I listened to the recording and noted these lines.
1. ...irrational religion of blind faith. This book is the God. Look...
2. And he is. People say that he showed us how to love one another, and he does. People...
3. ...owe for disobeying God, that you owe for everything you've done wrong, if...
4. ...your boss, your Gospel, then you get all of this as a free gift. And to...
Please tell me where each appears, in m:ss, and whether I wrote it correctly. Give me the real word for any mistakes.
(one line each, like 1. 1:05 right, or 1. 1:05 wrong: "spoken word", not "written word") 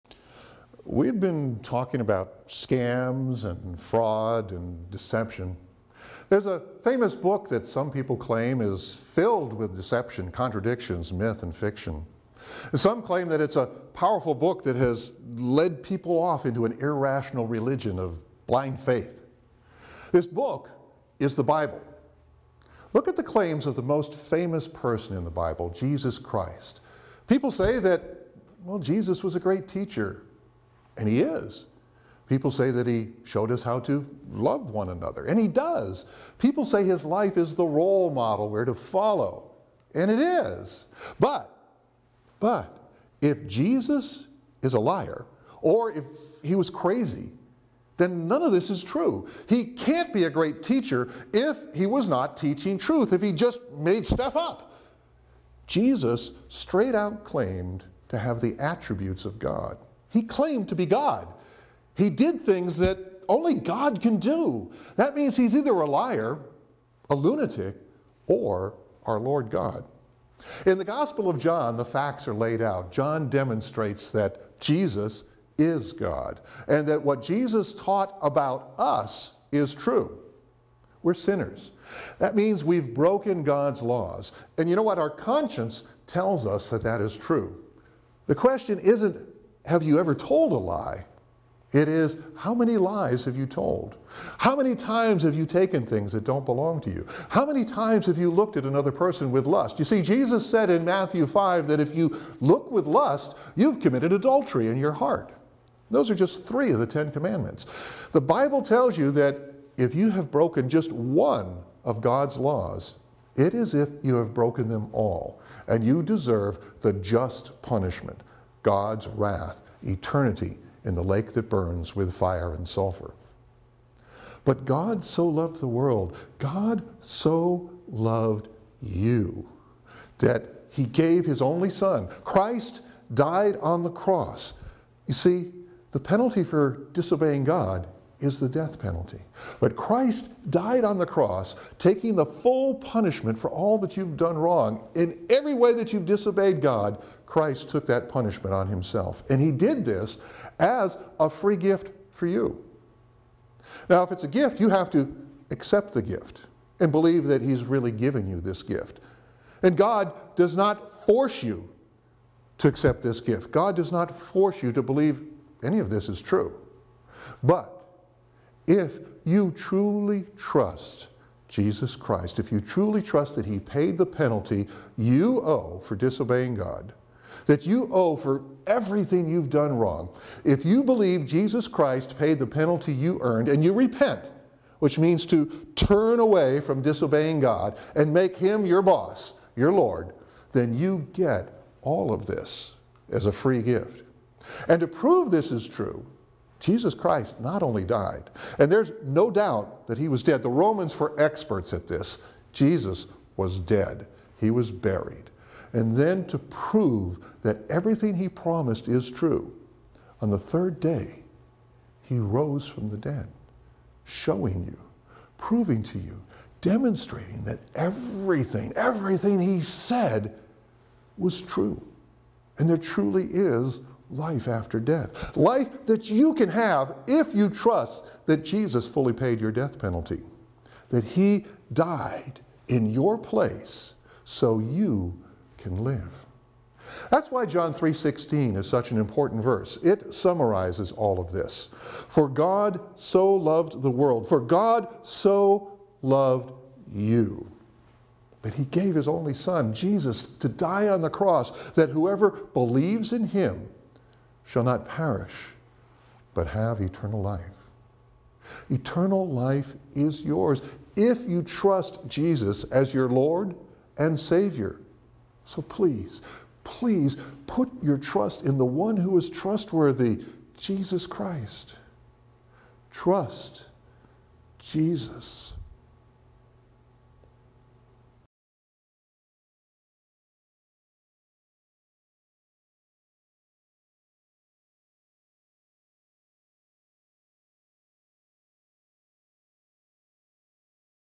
1. 0:16 wrong: "Bible", not "God"
2. 0:30 right
3. 2:55 right
4. 3:08 wrong: "Lord", not "Gospel".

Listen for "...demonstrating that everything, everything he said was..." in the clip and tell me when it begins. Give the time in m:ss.
3:36.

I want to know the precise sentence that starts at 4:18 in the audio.
Eternal life is yours if you trust Jesus as your Lord and Savior.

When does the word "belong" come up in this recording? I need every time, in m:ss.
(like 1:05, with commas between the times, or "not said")
1:36.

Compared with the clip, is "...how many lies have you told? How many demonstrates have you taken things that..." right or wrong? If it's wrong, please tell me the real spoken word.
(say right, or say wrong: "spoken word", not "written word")
wrong: "times", not "demonstrates".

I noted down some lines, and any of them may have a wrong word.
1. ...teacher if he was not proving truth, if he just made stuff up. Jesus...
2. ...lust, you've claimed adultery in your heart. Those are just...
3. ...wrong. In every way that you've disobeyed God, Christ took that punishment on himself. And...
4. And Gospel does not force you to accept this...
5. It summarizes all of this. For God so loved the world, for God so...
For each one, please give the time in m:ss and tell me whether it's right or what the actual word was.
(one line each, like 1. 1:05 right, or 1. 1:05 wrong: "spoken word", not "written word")
1. 0:50 wrong: "teaching", not "proving"
2. 1:42 wrong: "committed", not "claimed"
3. 2:24 right
4. 2:39 wrong: "God", not "Gospel"
5. 3:59 right.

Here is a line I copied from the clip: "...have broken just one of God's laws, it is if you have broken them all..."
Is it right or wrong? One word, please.
right.